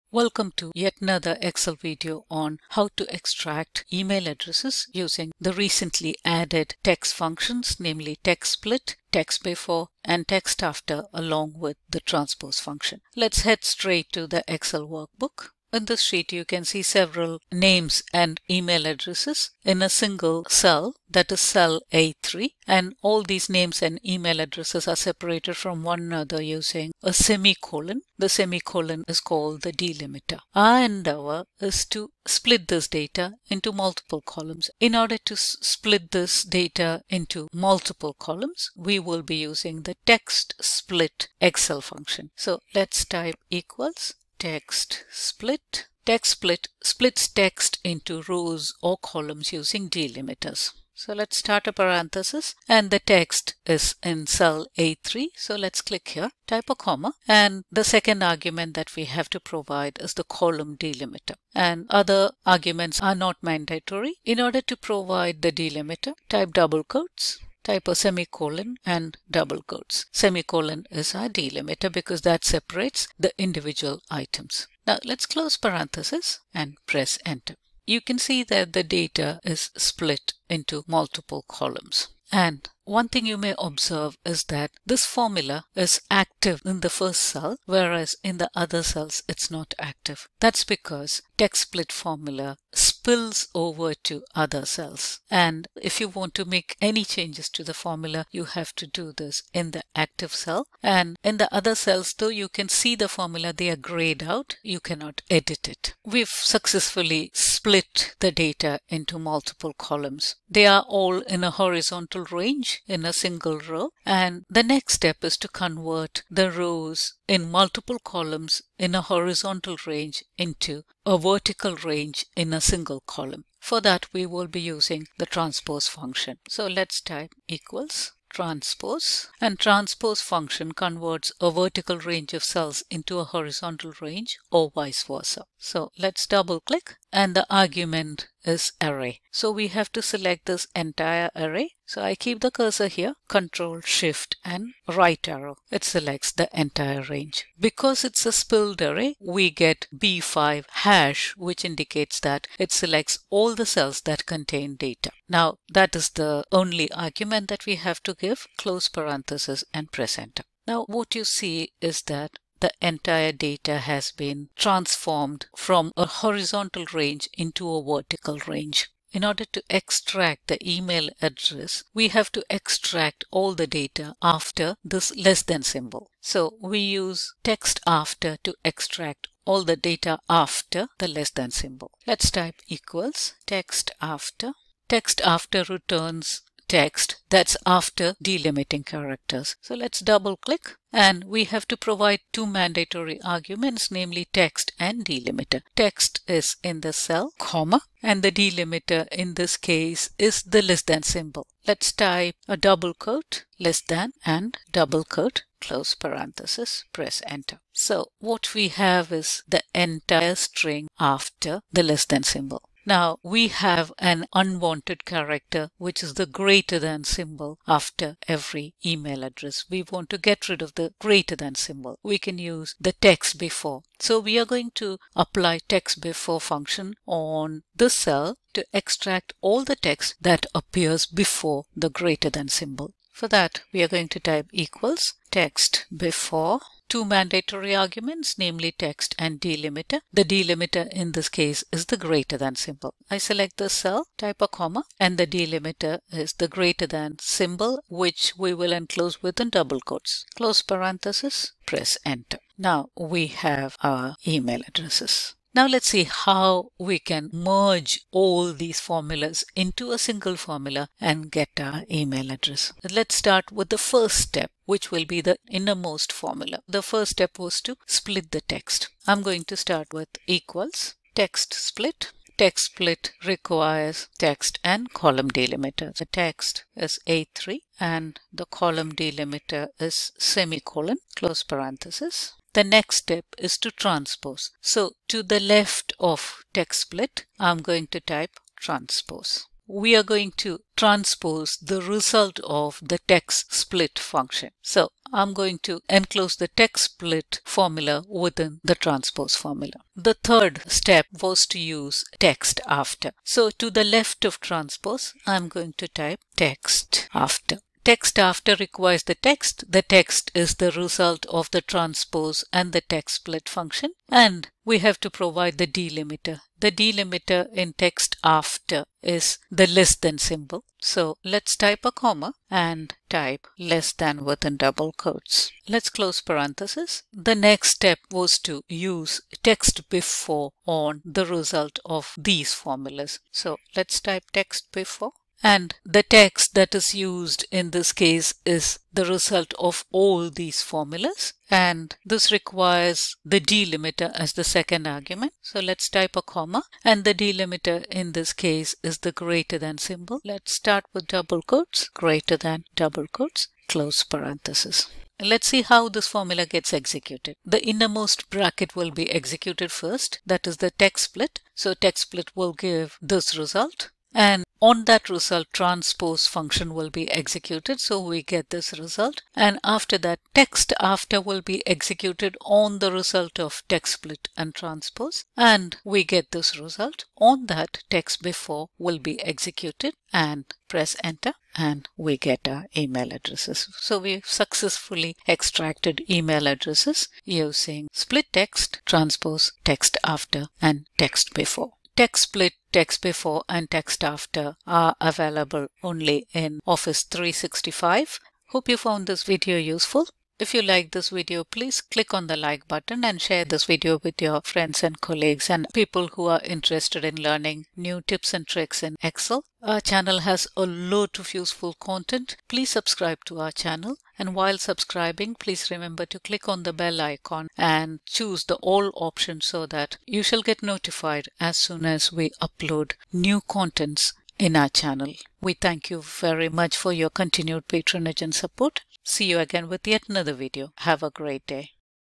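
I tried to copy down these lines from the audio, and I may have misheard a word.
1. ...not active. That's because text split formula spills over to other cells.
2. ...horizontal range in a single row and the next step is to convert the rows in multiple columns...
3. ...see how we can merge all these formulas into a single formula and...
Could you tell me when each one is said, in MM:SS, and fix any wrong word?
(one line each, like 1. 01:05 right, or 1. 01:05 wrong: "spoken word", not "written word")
1. 01:29 right
2. 01:51 right
3. 04:15 right.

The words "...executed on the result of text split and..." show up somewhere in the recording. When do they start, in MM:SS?
06:11.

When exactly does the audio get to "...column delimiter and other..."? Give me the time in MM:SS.
01:00.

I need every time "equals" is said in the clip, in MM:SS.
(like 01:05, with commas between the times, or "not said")
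00:43, 02:07, 03:02, 03:54, 04:30.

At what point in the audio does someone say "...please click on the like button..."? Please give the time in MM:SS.
06:41.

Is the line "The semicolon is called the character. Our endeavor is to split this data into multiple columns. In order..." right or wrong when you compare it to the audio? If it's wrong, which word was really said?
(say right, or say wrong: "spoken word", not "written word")
wrong: "delimiter", not "character".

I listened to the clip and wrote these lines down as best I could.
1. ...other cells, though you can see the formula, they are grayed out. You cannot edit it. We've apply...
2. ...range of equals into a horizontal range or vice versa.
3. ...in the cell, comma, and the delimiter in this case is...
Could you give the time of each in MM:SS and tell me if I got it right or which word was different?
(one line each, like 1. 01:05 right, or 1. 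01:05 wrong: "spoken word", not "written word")
1. 01:41 wrong: "successfully", not "apply"
2. 02:11 wrong: "cells", not "equals"
3. 03:16 right.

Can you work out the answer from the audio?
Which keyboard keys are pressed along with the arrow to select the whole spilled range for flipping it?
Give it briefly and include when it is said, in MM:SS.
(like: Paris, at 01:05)
Control Shift, at 02:23.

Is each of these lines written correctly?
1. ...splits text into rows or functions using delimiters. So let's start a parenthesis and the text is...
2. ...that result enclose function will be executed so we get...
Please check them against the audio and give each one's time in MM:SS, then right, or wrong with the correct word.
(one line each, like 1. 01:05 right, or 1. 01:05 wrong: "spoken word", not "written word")
1. 00:46 wrong: "columns", not "functions"
2. 06:04 wrong: "transpose", not "enclose".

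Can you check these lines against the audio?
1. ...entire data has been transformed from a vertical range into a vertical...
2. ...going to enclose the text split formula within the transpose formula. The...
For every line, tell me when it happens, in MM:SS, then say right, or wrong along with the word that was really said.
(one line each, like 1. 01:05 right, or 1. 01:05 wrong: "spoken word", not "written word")
1. 02:42 wrong: "horizontal", not "vertical"
2. 04:55 right.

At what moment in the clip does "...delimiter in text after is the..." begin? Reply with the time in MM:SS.
05:16.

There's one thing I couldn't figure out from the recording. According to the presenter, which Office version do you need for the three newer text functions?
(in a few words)
Office 365.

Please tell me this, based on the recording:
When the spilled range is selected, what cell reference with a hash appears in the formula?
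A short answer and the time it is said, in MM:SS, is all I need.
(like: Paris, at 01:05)
B5, at 02:29.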